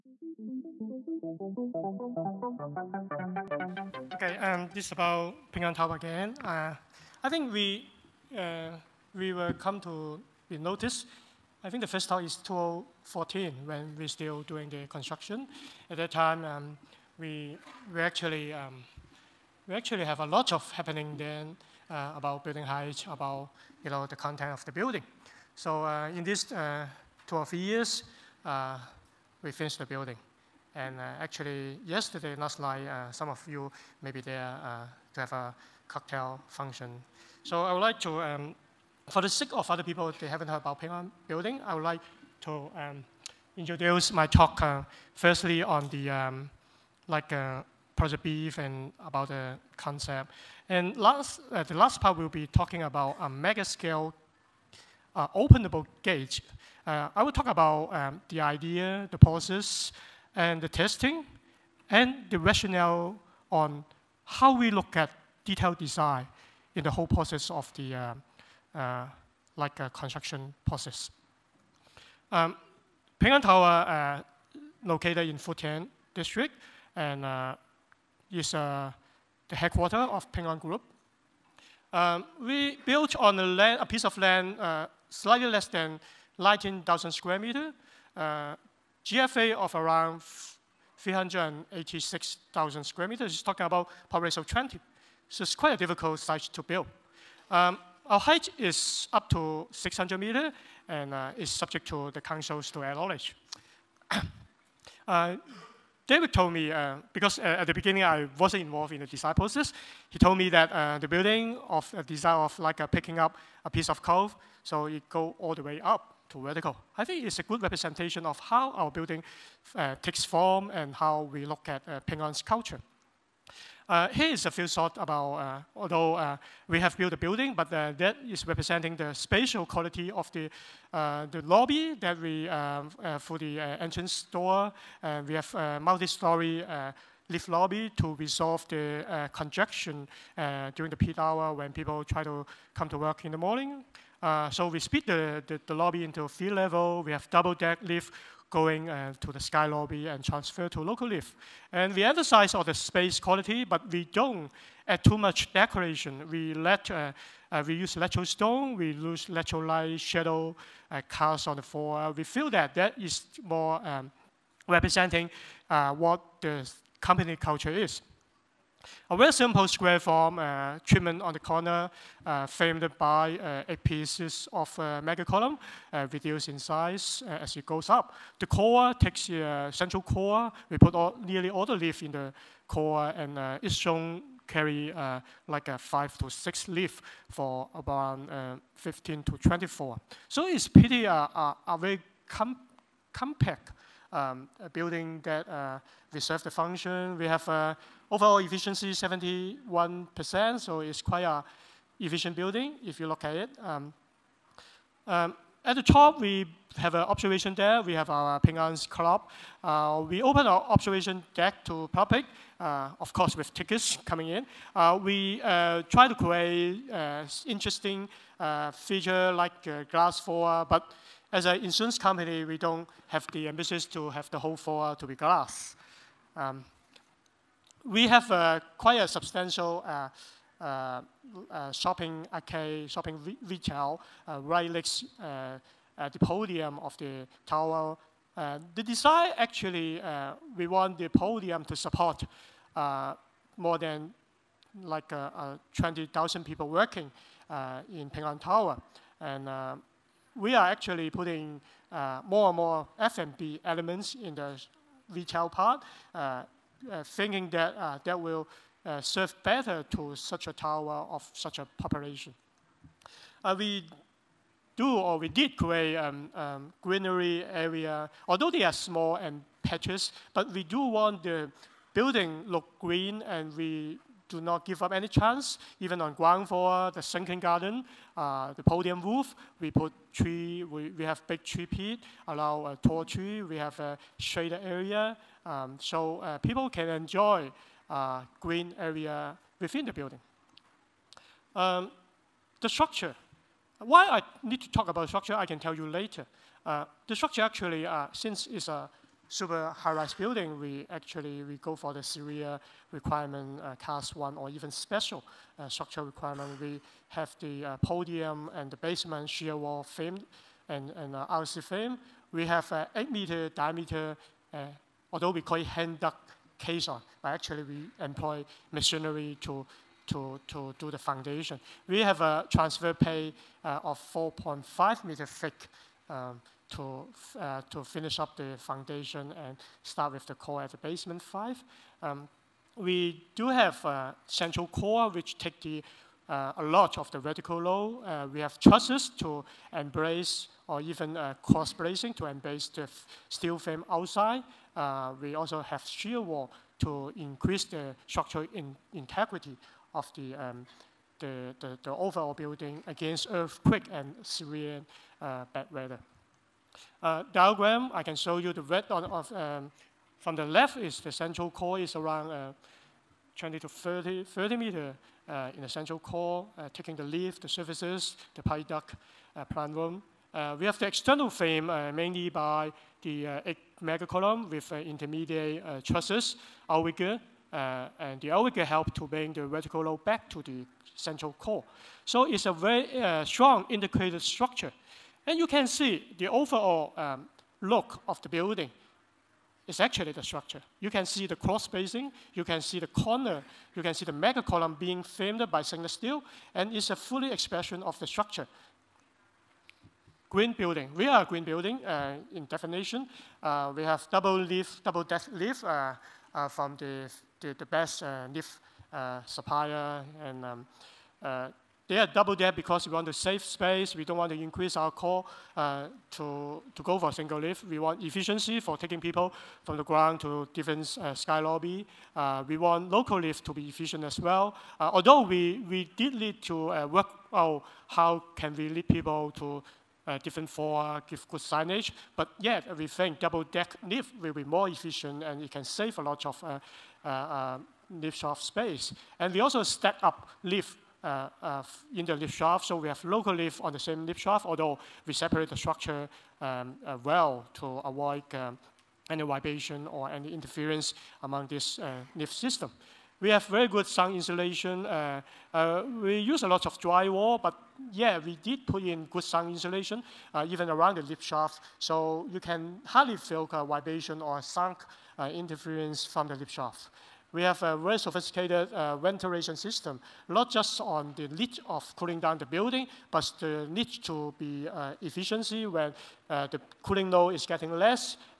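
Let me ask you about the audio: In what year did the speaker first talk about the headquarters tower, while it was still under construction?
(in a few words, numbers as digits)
2014.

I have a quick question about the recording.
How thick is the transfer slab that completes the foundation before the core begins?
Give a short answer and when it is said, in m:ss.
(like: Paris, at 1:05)
4.5 meters, at 5:24.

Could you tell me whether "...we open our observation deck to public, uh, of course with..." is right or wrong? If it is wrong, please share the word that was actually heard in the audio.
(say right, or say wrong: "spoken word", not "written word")
right.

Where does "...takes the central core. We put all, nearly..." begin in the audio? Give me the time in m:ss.
2:58.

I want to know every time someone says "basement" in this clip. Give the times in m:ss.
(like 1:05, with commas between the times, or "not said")
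5:08, 5:30.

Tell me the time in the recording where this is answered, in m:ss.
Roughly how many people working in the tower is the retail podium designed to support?
4:03.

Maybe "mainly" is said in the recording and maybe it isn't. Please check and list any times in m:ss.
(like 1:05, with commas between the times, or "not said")
6:11.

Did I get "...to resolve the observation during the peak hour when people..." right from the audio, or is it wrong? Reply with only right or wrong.
wrong.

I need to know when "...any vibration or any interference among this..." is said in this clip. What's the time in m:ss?
7:29.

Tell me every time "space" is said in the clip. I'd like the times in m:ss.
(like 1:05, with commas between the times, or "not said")
2:32, 6:53, 7:18.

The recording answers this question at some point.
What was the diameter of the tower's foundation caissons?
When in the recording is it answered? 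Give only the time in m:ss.
5:12.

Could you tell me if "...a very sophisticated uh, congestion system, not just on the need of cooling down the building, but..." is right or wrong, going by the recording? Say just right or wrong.
wrong.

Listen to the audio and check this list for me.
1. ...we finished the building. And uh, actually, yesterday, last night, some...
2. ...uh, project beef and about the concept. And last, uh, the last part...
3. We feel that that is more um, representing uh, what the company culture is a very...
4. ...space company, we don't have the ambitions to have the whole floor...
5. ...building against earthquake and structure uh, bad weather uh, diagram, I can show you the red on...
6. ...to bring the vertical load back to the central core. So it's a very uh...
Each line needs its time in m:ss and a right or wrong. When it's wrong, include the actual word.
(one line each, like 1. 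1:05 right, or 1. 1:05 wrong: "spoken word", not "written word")
1. 0:29 right
2. 0:47 right
3. 2:42 right
4. 3:41 wrong: "insurance", not "space"
5. 5:52 wrong: "severe", not "structure"
6. 6:18 right.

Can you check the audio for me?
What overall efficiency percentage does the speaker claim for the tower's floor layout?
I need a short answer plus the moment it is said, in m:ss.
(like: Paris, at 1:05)
71%, at 3:18.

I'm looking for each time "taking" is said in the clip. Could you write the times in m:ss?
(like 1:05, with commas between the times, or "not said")
6:06, 6:58.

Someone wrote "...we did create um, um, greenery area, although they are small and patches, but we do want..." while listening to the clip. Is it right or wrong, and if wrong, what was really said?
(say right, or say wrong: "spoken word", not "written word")
right.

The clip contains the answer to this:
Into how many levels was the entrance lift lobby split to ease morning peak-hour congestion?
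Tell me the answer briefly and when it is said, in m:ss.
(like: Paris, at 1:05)
3, at 2:26.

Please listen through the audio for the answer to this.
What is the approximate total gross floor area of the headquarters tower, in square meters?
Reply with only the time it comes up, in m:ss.
1:30.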